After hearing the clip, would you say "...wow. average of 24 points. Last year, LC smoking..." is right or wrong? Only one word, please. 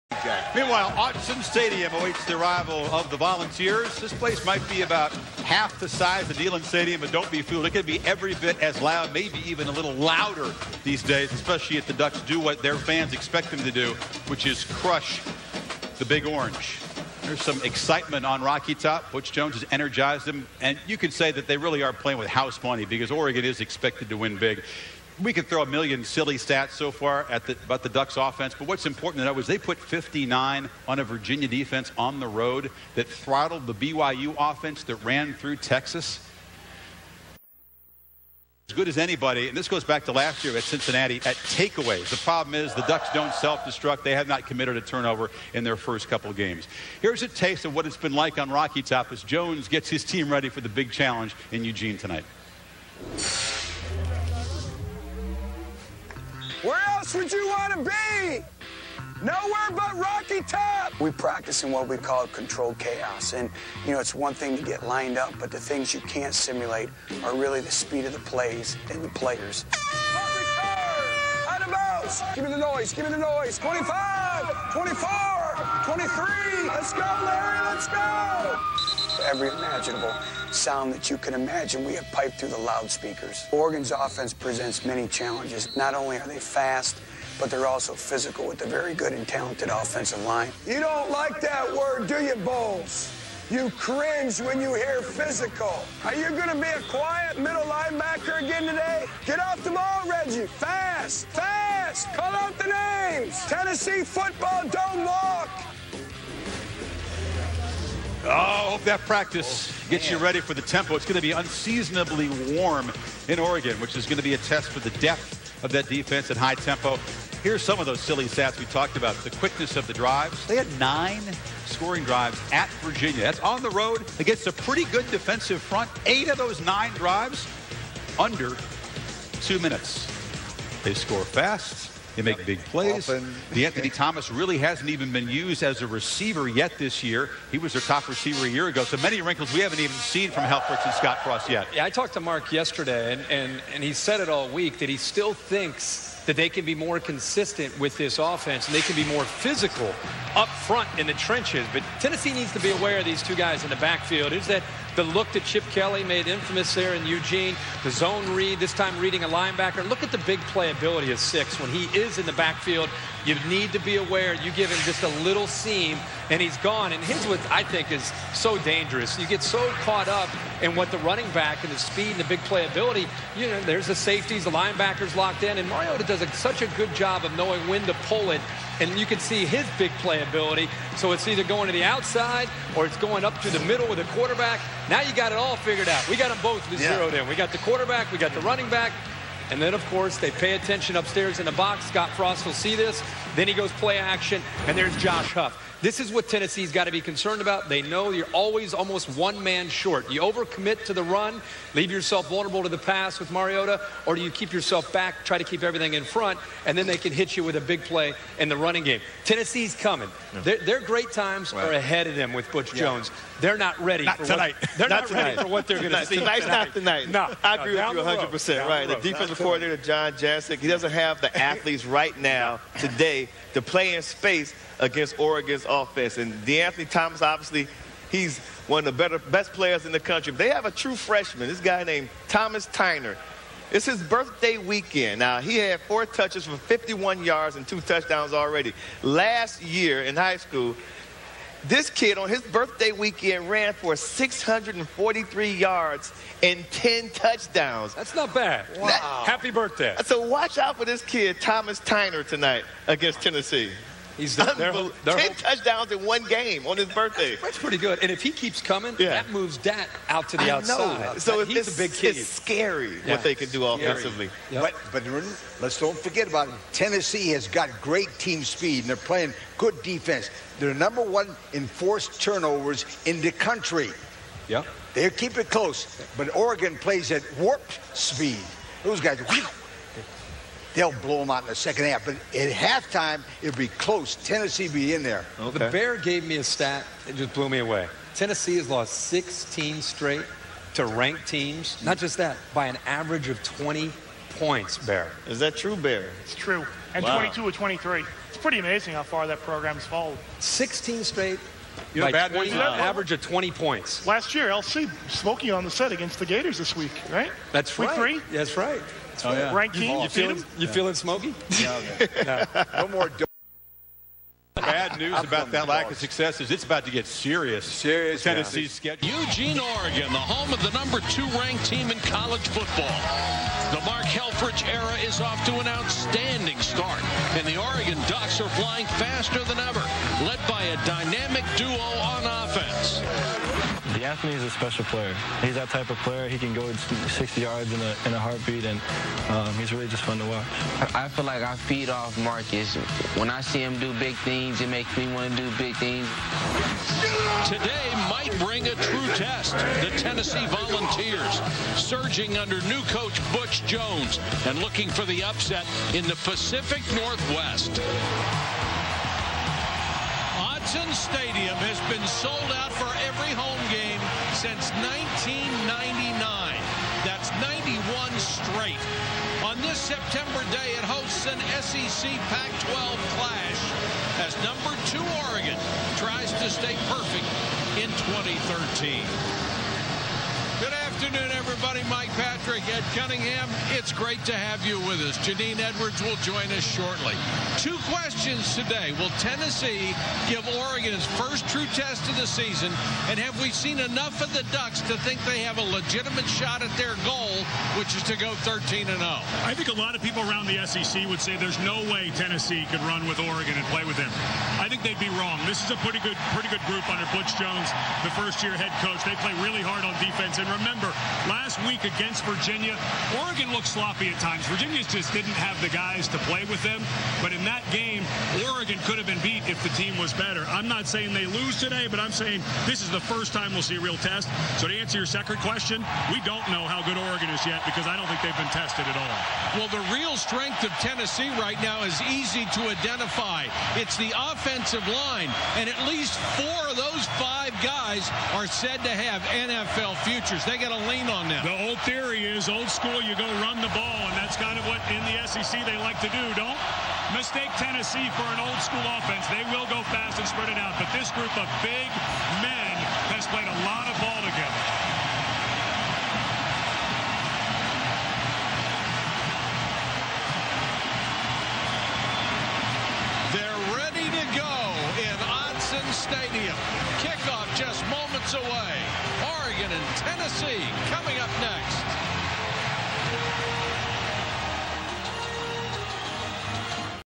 wrong.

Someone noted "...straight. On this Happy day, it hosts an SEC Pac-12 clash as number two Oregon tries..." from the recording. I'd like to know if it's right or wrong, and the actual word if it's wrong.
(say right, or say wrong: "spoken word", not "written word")
wrong: "September", not "Happy".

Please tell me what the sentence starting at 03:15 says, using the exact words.
This is what Tennessee's got to be concerned about.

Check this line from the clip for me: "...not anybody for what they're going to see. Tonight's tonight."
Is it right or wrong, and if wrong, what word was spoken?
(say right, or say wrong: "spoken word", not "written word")
wrong: "ready", not "anybody".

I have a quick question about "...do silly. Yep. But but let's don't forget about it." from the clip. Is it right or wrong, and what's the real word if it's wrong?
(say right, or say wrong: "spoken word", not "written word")
wrong: "offensively", not "silly".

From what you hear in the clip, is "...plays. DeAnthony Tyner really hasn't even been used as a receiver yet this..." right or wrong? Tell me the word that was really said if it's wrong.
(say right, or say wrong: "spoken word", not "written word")
wrong: "Thomas", not "Tyner".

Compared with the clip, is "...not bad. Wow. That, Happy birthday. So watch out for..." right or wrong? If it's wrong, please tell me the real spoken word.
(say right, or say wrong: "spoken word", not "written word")
right.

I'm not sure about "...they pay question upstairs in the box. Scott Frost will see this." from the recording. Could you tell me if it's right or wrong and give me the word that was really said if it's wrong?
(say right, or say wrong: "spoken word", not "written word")
wrong: "attention", not "question".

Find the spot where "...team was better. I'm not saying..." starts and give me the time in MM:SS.
06:59.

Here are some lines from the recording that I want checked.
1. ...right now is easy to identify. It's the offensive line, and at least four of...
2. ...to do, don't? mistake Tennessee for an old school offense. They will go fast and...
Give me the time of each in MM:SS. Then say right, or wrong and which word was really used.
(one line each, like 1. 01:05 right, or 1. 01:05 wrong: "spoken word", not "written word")
1. 07:11 right
2. 07:26 right.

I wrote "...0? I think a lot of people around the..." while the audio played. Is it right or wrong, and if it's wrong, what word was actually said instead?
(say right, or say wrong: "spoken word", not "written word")
right.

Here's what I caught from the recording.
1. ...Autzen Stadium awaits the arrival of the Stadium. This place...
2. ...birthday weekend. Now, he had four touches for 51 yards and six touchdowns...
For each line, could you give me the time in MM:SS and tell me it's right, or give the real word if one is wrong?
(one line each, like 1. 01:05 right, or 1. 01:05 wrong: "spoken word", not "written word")
1. 00:00 wrong: "Volunteers", not "Stadium"
2. 03:54 wrong: "two", not "six".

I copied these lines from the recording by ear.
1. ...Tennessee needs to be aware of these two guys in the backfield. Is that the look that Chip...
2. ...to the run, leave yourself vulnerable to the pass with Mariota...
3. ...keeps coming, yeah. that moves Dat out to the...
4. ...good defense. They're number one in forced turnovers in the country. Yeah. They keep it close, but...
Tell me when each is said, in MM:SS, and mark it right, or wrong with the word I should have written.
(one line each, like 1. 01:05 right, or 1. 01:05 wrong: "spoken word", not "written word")
1. 02:31 right
2. 03:20 right
3. 04:18 right
4. 04:29 right.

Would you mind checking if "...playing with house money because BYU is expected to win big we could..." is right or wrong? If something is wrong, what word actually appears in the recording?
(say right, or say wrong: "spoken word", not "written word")
wrong: "Oregon", not "BYU".